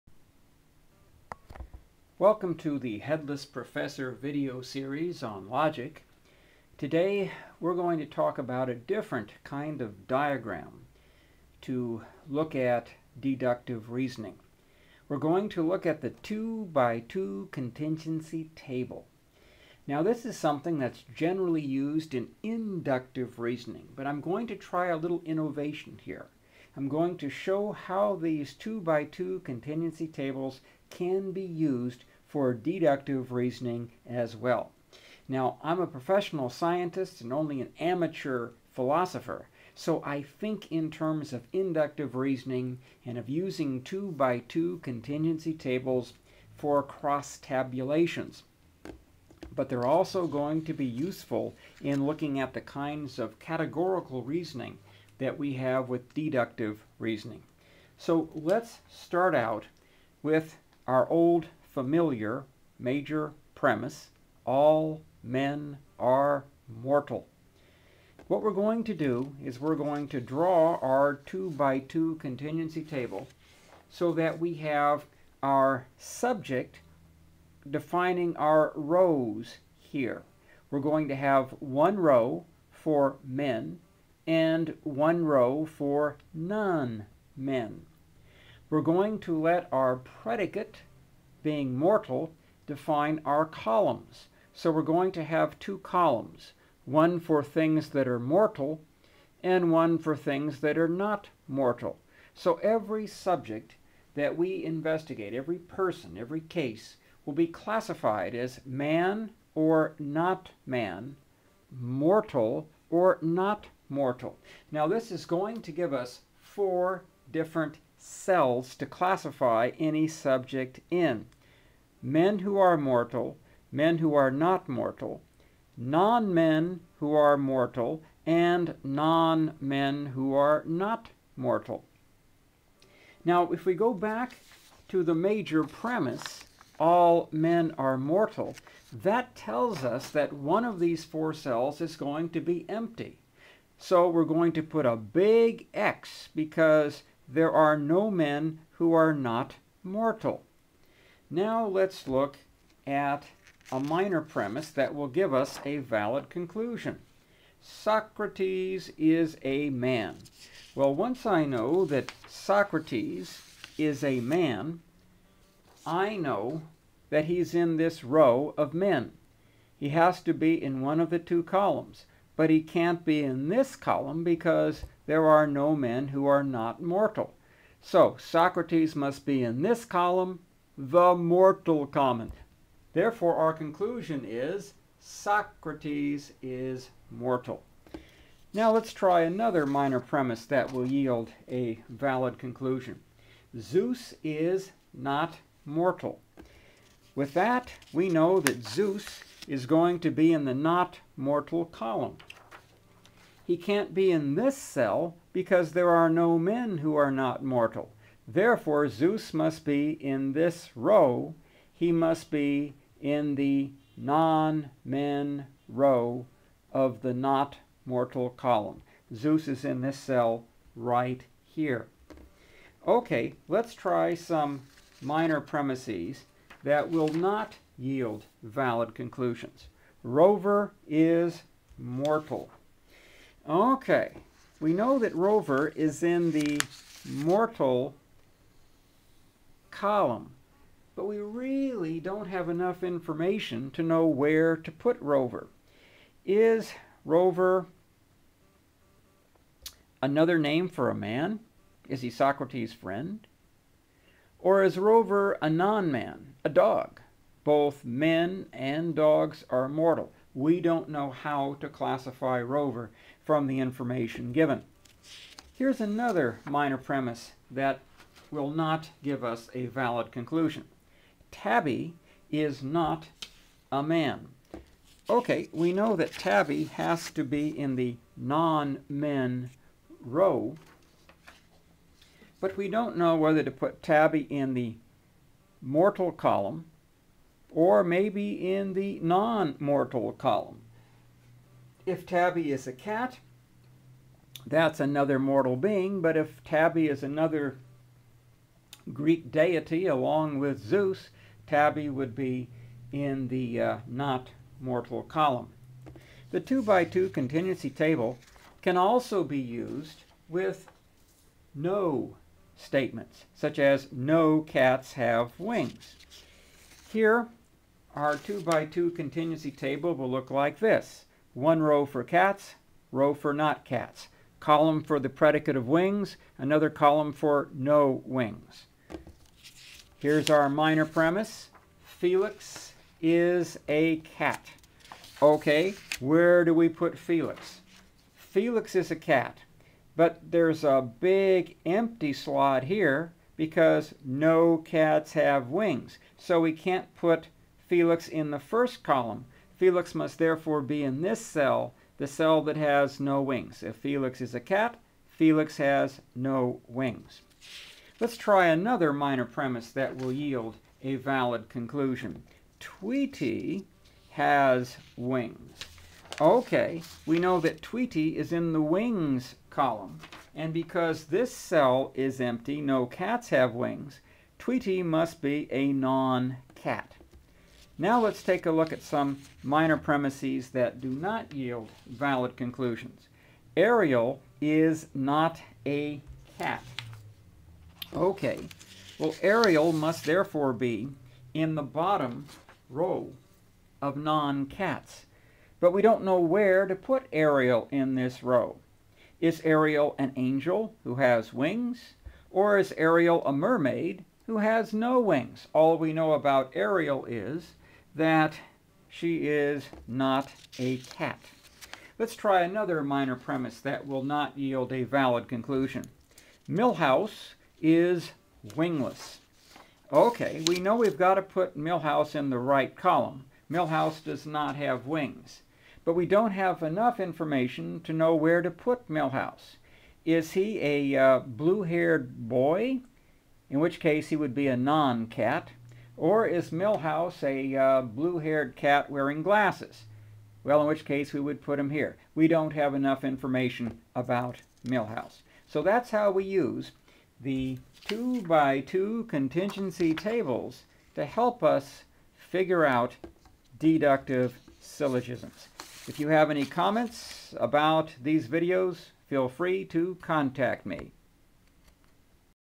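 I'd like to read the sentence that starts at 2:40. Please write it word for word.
Well, once I know that Socrates is a man, I know that he's in this row of men.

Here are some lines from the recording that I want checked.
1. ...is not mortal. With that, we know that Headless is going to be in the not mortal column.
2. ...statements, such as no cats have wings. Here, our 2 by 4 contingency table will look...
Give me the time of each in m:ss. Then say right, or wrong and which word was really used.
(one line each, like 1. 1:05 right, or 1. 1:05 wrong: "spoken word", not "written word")
1. 3:14 wrong: "Zeus", not "Headless"
2. 5:12 wrong: "2", not "4".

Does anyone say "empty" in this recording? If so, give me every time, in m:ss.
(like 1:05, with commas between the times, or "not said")
2:22, 5:41, 6:12.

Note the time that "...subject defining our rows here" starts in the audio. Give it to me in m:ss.
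1:15.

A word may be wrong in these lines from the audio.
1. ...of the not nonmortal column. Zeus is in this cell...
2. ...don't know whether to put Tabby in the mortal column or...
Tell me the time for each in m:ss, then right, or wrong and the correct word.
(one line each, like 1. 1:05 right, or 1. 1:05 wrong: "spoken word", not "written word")
1. 3:36 wrong: "mortal", not "nonmortal"
2. 4:42 right.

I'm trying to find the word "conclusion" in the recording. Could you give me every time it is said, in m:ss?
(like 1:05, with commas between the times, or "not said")
2:36, 3:03, 3:12, 3:48, 4:30, 6:01, 6:22, 6:55.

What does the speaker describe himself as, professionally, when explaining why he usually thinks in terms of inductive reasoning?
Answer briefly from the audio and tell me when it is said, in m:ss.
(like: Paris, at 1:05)
professional scientist, at 0:35.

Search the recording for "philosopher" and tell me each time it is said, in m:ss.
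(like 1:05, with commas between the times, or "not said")
0:38.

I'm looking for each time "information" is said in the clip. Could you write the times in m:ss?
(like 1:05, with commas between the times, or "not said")
4:02, 4:23, 7:06, 7:23.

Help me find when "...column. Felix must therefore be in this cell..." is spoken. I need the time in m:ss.
5:48.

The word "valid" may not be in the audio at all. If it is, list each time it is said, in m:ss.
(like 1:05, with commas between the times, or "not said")
2:35, 3:11, 3:48, 4:29, 6:00, 6:21, 6:54.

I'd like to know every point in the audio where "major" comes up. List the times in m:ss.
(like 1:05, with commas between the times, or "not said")
1:02, 2:15.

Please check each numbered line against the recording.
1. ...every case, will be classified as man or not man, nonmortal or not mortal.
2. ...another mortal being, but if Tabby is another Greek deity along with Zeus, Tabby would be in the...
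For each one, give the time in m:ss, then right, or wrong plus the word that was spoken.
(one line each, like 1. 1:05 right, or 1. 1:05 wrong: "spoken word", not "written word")
1. 1:46 wrong: "mortal", not "nonmortal"
2. 4:54 right.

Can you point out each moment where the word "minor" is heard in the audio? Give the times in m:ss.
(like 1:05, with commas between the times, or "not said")
2:33, 3:09, 3:45, 4:26, 5:30, 5:58, 6:19, 6:52.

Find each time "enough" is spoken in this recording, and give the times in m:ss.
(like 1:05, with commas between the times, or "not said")
4:02, 7:06, 7:22.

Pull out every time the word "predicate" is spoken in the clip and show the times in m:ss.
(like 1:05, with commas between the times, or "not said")
1:29, 5:25.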